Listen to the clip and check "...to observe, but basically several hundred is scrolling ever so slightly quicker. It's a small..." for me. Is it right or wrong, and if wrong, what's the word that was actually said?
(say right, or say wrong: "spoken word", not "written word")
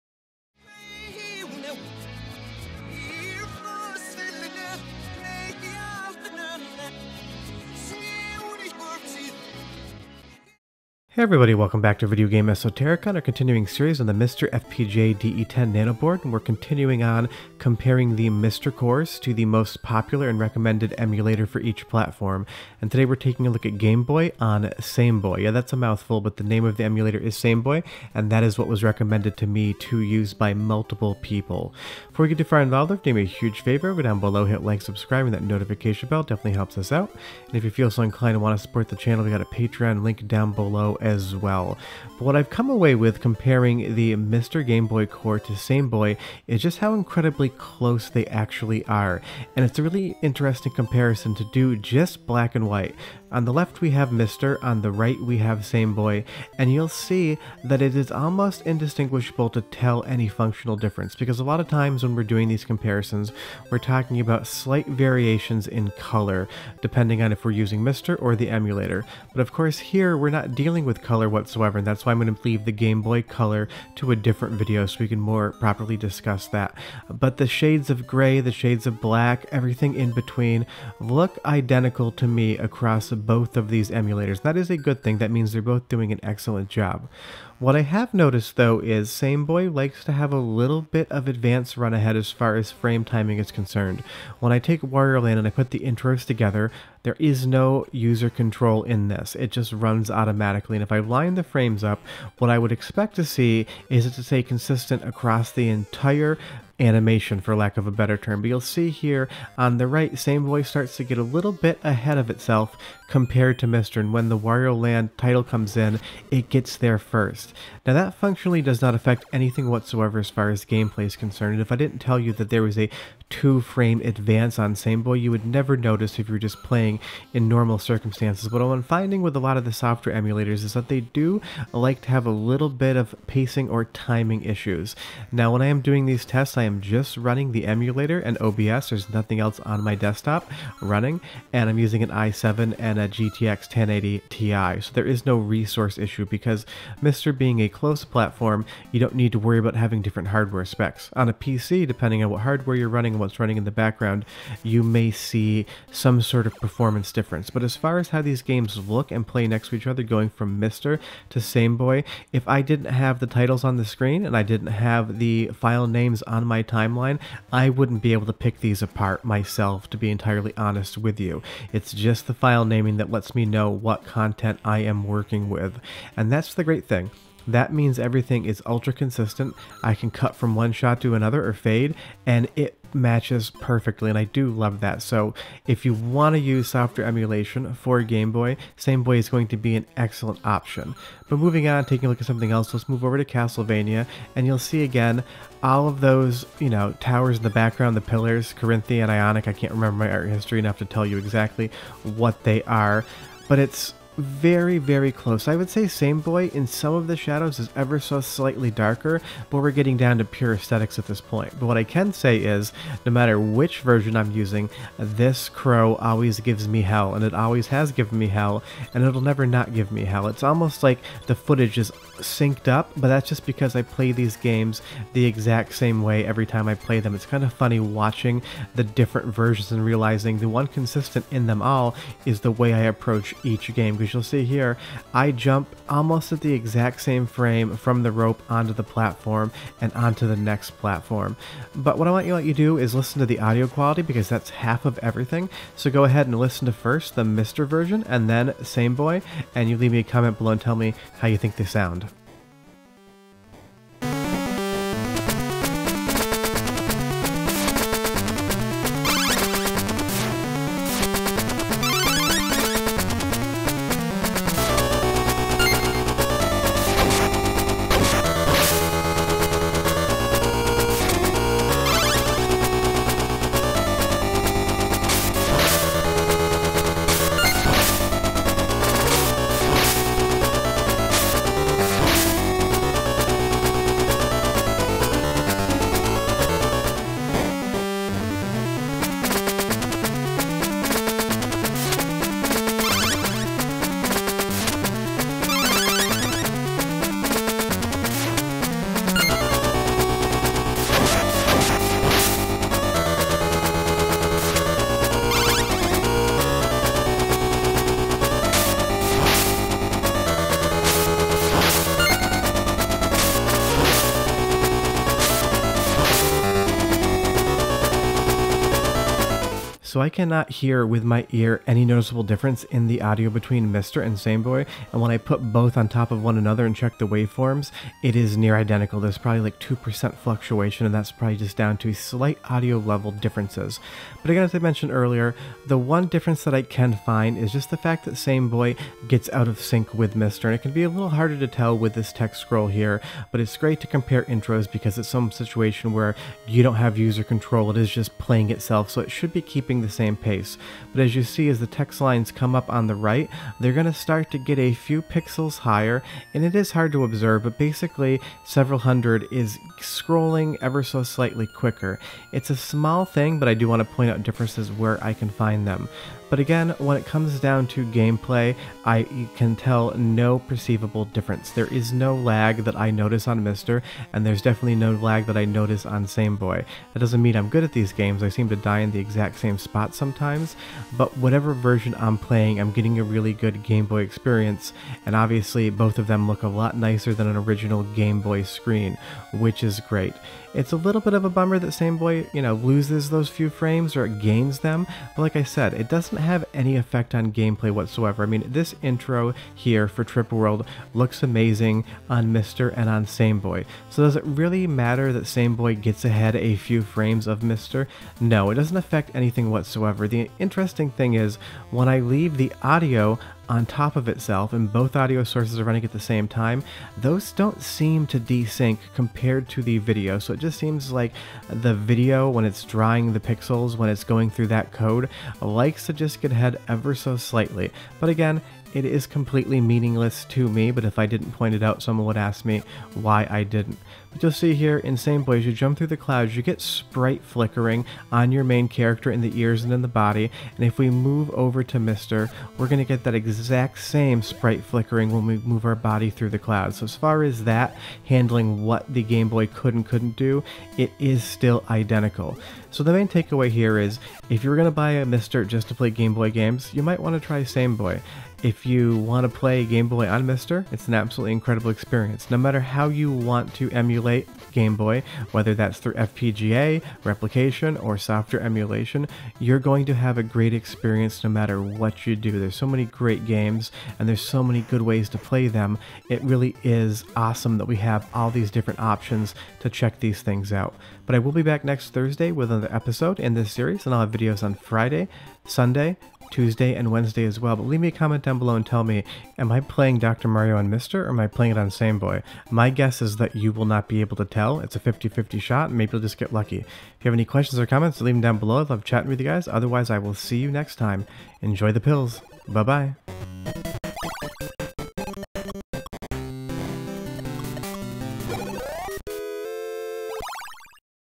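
right.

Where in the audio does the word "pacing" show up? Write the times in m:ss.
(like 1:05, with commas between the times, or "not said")
2:13.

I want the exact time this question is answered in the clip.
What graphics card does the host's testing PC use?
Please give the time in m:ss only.
2:23.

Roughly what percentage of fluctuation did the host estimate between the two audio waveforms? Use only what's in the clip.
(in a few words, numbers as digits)
2%.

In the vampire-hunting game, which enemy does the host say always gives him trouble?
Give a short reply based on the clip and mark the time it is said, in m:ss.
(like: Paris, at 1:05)
crow, at 3:35.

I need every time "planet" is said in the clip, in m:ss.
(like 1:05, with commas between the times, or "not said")
not said.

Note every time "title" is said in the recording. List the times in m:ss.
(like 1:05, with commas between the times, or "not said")
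1:55, 2:43.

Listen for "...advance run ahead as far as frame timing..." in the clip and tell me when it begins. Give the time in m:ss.
1:31.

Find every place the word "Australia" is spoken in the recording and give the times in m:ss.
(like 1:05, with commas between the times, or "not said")
not said.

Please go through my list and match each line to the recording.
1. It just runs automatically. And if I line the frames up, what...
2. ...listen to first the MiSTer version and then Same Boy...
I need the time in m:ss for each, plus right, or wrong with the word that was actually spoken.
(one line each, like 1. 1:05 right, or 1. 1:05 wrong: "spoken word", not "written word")
1. 1:39 right
2. 4:06 right.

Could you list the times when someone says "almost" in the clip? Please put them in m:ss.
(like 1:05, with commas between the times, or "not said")
0:58, 3:40, 3:55.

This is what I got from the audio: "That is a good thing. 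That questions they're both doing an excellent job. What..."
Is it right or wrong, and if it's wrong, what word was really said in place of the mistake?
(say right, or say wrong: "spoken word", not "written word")
wrong: "means", not "questions".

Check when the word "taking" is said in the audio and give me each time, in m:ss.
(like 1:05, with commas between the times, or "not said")
0:23, 3:11.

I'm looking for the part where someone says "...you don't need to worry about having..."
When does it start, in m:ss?
2:28.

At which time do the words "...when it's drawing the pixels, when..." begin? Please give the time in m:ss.
7:02.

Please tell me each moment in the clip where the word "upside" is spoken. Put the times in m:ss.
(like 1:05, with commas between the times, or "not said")
not said.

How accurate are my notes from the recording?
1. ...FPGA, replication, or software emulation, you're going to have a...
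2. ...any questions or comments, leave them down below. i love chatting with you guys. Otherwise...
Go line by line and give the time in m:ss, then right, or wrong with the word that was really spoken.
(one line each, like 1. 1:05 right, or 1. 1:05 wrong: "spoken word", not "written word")
1. 7:45 right
2. 8:17 right.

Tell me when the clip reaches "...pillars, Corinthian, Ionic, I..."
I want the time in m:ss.
3:18.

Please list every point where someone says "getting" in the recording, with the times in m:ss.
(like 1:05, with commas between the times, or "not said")
3:29, 6:22.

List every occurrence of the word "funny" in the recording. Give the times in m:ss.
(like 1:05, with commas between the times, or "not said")
3:47.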